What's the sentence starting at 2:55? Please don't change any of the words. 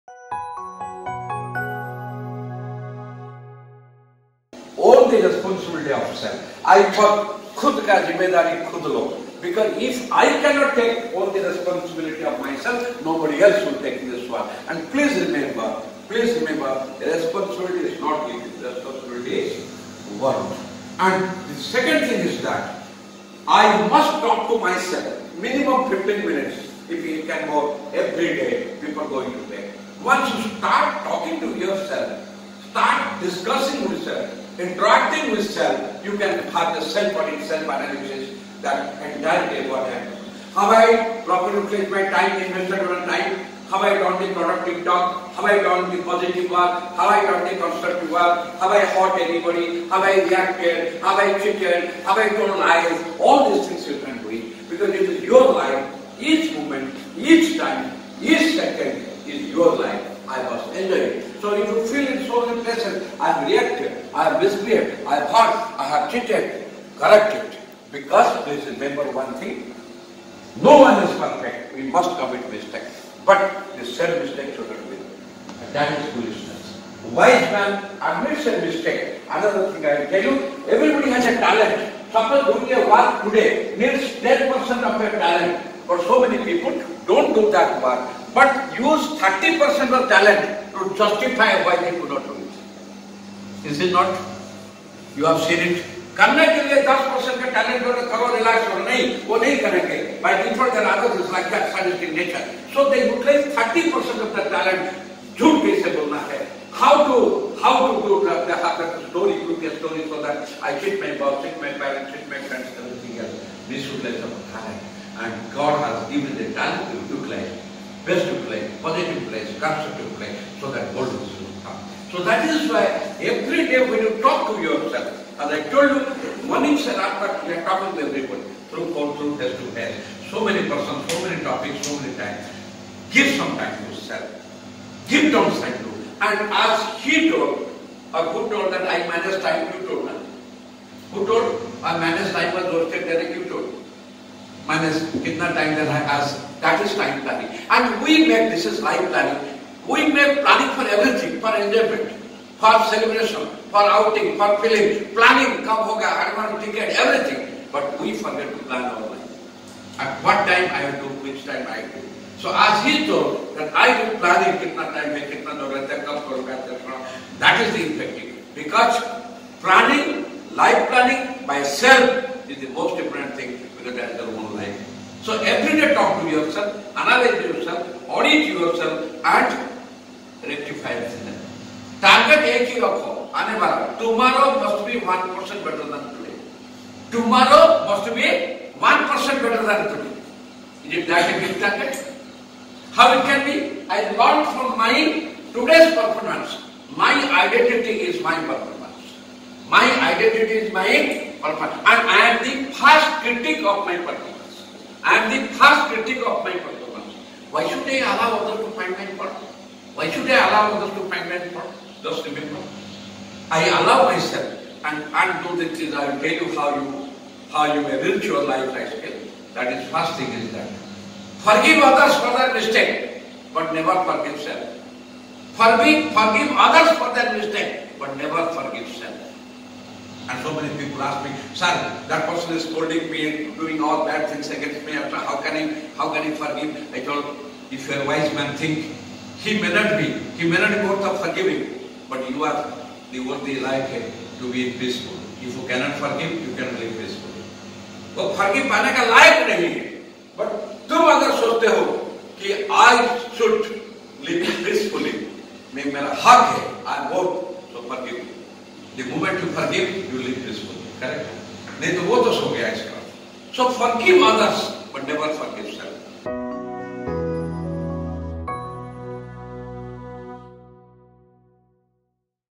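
So every day talk to yourself, analyze yourself, audit yourself and rectify yourself.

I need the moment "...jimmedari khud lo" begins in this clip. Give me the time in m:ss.
0:08.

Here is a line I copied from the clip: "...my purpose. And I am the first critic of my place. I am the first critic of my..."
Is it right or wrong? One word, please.
wrong.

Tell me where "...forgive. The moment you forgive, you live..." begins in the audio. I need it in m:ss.
4:17.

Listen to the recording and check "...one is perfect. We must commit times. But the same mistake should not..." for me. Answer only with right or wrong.
wrong.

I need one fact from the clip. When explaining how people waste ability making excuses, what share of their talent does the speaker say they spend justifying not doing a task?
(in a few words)
30%.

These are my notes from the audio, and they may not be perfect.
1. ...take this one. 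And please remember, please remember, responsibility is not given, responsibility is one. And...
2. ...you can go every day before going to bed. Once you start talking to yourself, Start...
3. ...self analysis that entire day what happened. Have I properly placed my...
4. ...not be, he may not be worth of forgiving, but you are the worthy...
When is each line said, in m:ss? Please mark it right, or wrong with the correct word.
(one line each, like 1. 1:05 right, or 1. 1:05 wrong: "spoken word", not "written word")
1. 0:13 right
2. 0:27 right
3. 0:37 right
4. 3:59 right.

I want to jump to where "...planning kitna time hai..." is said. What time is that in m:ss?
2:44.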